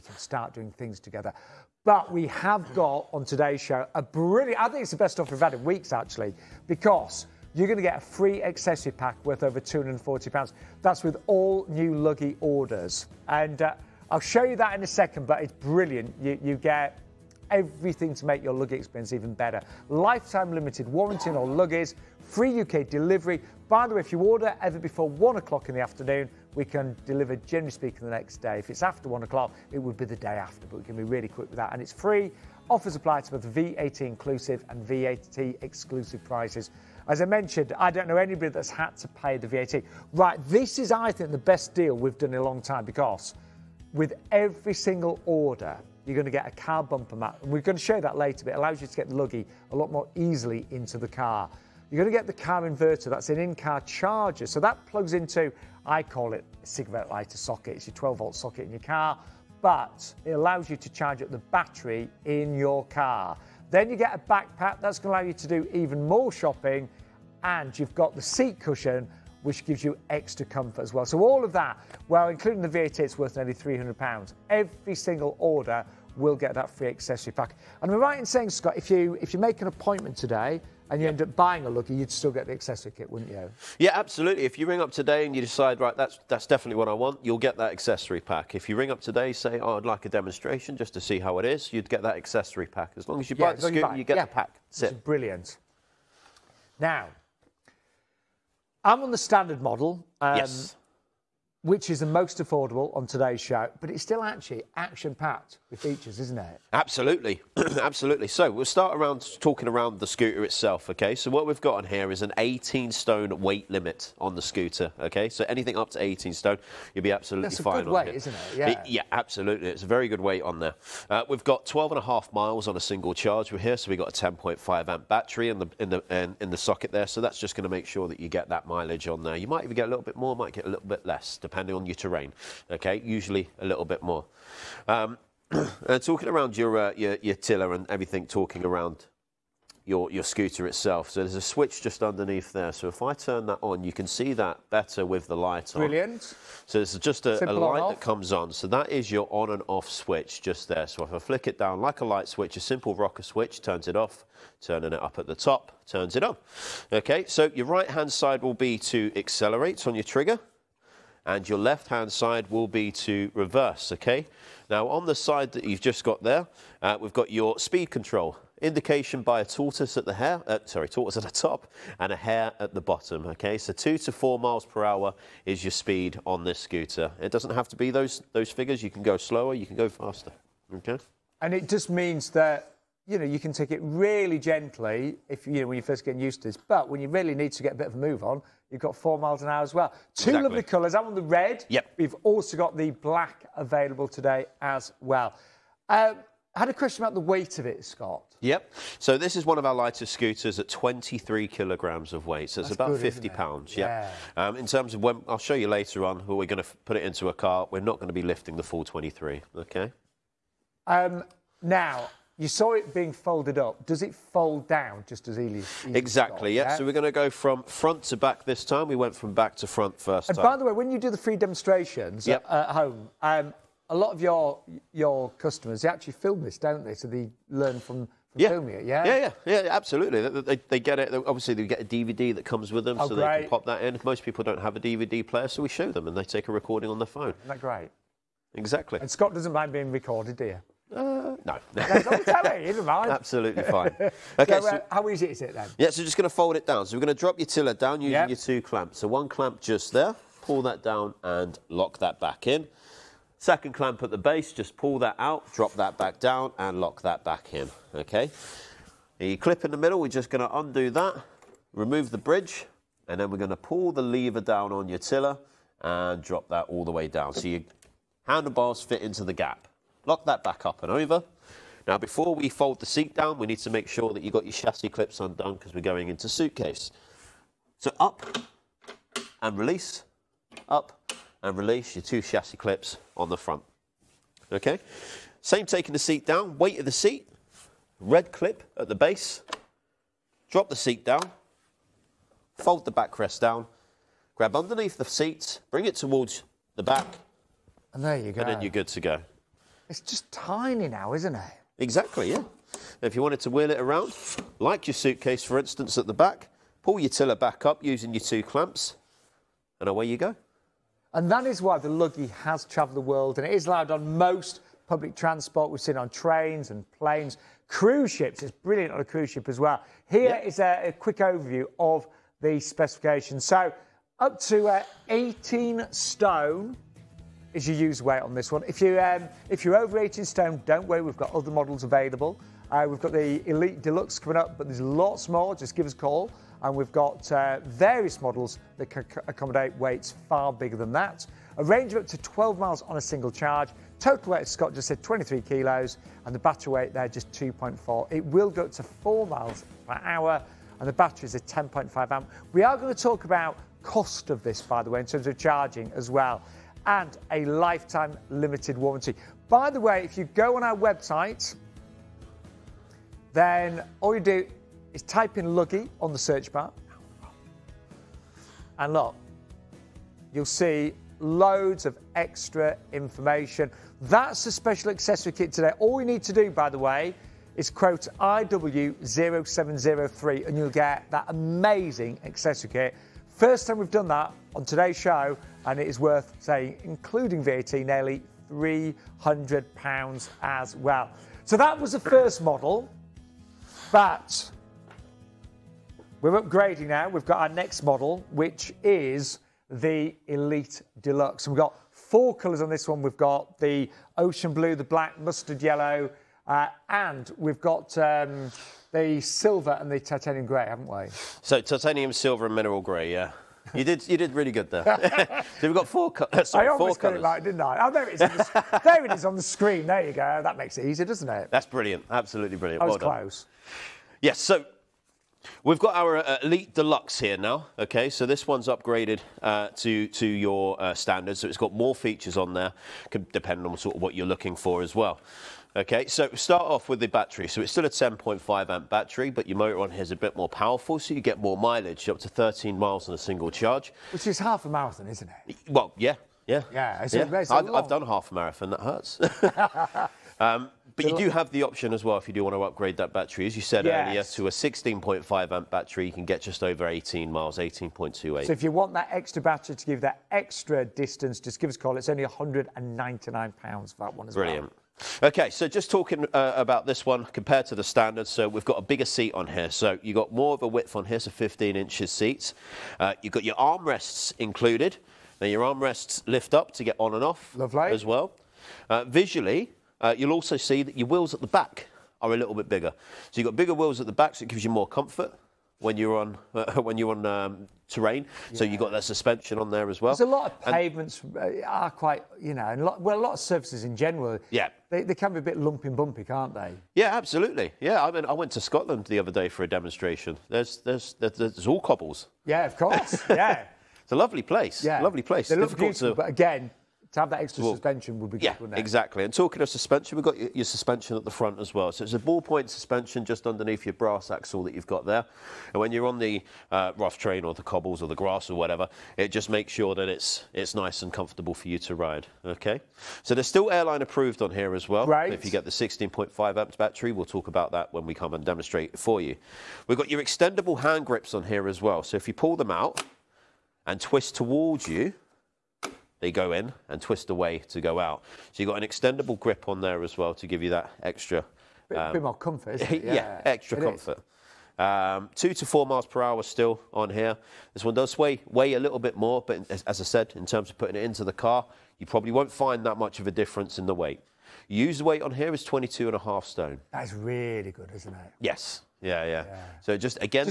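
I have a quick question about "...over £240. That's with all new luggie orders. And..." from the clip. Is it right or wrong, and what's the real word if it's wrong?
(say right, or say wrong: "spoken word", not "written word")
right.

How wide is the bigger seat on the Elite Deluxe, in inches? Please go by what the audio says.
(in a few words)
15 inches.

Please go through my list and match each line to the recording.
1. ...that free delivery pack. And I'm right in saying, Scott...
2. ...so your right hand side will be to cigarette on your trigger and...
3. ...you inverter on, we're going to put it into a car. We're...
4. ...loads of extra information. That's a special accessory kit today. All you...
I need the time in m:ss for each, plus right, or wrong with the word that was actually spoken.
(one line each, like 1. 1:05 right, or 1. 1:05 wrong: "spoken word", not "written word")
1. 1:16 wrong: "accessory", not "delivery"
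2. 2:37 wrong: "accelerate", not "cigarette"
3. 3:25 wrong: "later", not "inverter"
4. 6:11 right.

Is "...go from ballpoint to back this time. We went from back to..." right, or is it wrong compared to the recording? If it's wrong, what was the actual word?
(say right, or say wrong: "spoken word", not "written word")
wrong: "front", not "ballpoint".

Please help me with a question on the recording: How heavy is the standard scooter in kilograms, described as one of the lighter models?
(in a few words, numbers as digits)
23 kilograms.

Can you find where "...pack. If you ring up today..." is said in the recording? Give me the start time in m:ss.
1:28.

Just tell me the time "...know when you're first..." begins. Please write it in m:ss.
3:05.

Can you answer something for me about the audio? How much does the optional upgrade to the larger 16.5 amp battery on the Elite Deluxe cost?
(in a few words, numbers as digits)
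£199.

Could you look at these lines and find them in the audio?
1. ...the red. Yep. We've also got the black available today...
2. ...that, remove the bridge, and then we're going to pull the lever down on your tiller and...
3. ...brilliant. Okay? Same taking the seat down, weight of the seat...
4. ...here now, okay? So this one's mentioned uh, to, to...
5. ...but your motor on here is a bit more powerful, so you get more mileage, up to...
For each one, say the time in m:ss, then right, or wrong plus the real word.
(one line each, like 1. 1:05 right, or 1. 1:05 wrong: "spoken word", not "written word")
1. 3:11 right
2. 4:20 right
3. 4:43 wrong: "front", not "brilliant"
4. 7:07 wrong: "upgraded", not "mentioned"
5. 7:19 right.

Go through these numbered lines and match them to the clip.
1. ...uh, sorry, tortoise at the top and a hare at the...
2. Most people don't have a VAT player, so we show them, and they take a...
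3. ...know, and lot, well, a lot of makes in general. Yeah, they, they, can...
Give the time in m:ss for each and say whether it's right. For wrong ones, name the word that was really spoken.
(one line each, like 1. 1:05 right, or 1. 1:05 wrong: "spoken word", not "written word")
1. 2:50 right
2. 3:54 wrong: "DVD", not "VAT"
3. 8:12 wrong: "surfaces", not "makes".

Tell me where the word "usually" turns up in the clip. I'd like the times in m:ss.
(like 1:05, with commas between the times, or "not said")
2:13.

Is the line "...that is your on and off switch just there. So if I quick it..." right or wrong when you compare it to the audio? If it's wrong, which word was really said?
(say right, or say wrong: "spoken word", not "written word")
wrong: "flick", not "quick".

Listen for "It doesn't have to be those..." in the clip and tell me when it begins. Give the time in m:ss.
2:57.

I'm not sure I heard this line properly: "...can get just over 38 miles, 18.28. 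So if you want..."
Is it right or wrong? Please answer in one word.
wrong.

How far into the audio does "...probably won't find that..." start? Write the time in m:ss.
9:12.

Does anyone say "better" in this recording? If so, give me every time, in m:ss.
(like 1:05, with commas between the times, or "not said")
0:19, 2:24.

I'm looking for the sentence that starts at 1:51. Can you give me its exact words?
So what we've got on here is an 18 stone weight limit on the scooter, okay?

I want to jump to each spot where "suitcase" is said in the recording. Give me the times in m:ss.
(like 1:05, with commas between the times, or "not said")
4:36, 5:04.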